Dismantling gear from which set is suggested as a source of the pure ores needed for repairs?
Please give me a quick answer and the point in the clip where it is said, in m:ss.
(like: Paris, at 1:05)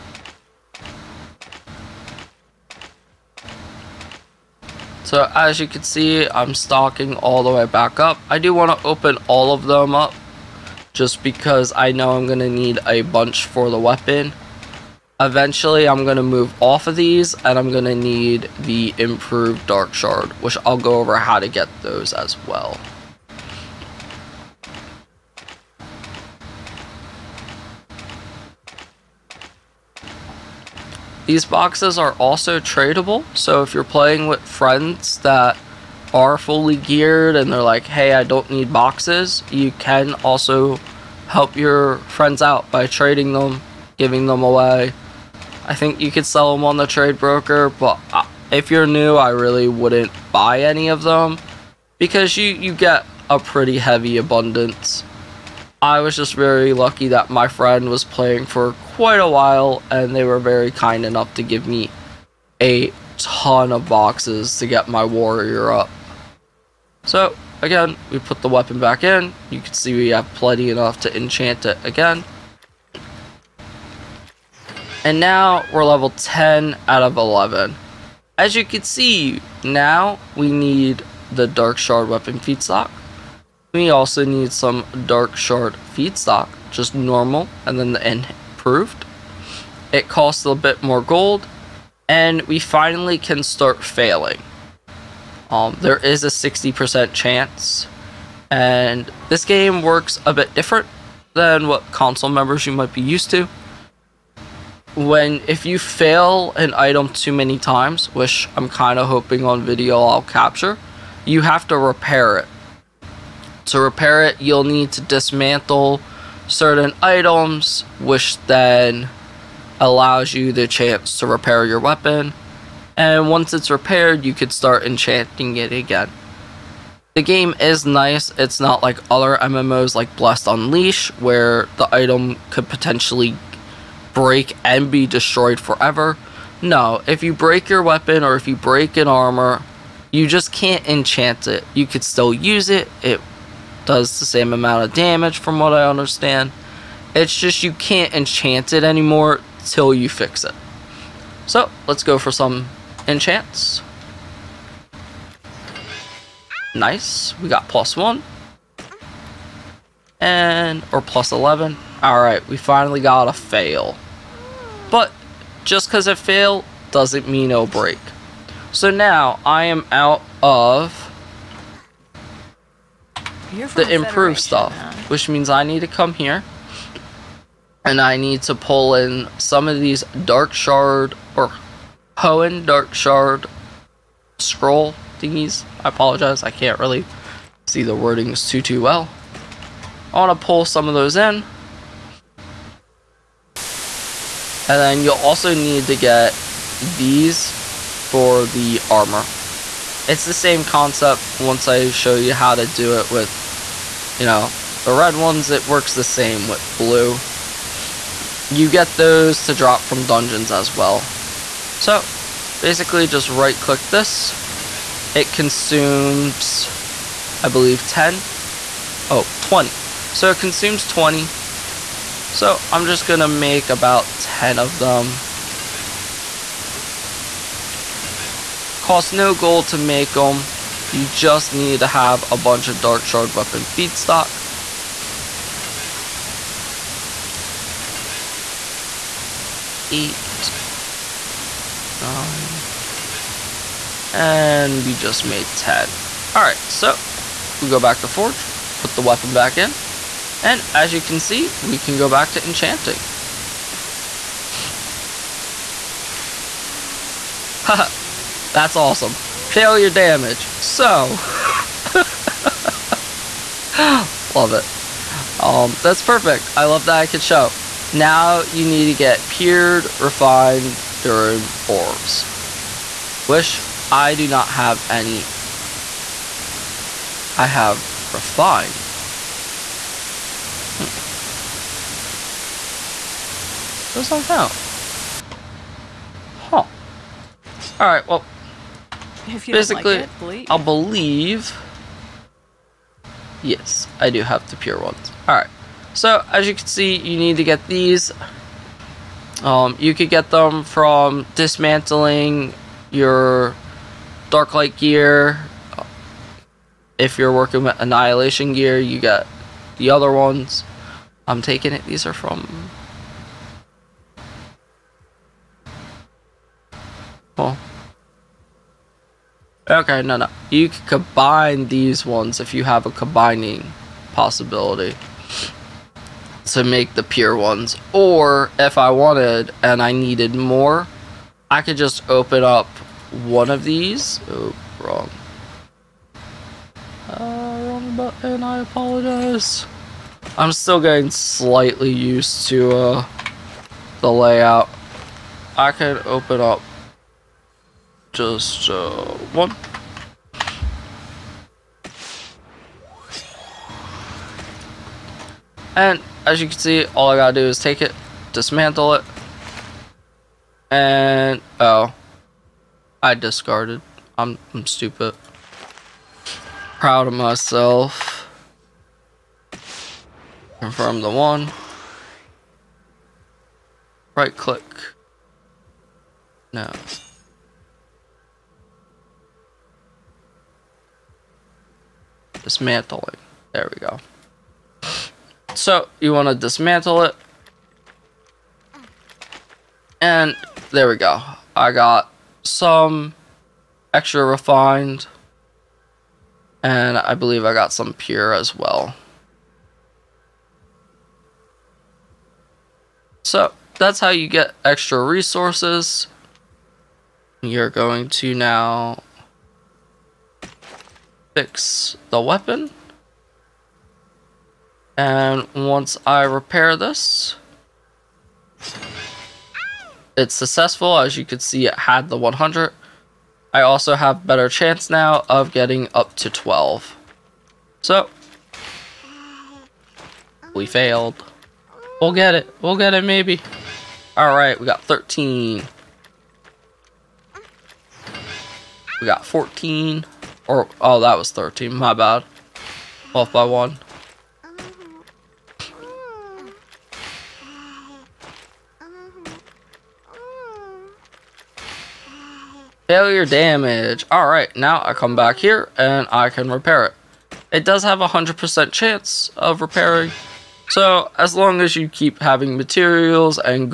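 dark light gear, at 5:04.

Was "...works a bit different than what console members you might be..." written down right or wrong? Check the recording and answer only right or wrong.
right.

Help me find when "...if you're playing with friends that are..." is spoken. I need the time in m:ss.
0:33.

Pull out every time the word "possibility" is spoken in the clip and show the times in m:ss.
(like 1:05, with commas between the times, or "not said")
5:24.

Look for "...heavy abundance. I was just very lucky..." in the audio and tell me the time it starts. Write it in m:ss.
0:53.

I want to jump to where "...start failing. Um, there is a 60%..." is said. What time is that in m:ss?
1:33.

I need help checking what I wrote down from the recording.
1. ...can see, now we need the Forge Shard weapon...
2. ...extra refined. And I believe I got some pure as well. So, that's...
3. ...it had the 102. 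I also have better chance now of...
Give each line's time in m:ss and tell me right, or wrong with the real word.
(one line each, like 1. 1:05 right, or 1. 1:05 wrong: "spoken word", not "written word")
1. 1:18 wrong: "Dark", not "Forge"
2. 6:33 right
3. 7:01 wrong: "100", not "102".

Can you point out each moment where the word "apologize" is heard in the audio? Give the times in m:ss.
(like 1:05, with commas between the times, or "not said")
3:05, 5:38.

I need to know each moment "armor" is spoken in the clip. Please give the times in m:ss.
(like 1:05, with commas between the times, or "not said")
2:19, 3:18.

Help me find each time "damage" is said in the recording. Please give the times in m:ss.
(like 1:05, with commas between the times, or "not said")
2:24, 4:19, 7:33.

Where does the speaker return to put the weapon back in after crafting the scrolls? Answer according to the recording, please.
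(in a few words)
Forge.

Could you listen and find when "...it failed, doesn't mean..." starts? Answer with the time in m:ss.
2:46.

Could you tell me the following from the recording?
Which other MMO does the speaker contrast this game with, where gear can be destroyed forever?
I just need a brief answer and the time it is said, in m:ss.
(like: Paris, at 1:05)
Blast Unleash, at 2:10.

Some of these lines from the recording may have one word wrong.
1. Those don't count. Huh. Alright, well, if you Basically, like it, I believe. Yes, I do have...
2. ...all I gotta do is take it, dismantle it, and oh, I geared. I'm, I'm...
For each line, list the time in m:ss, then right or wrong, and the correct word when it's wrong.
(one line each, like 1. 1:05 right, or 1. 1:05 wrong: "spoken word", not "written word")
1. 4:43 right
2. 5:56 wrong: "discarded", not "geared".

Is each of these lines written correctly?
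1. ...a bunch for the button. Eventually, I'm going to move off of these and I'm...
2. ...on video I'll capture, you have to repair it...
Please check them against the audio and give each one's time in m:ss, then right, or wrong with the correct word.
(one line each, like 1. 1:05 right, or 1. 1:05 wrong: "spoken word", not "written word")
1. 0:12 wrong: "weapon", not "button"
2. 1:49 right.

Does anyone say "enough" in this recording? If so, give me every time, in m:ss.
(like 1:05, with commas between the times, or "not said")
1:01, 1:10.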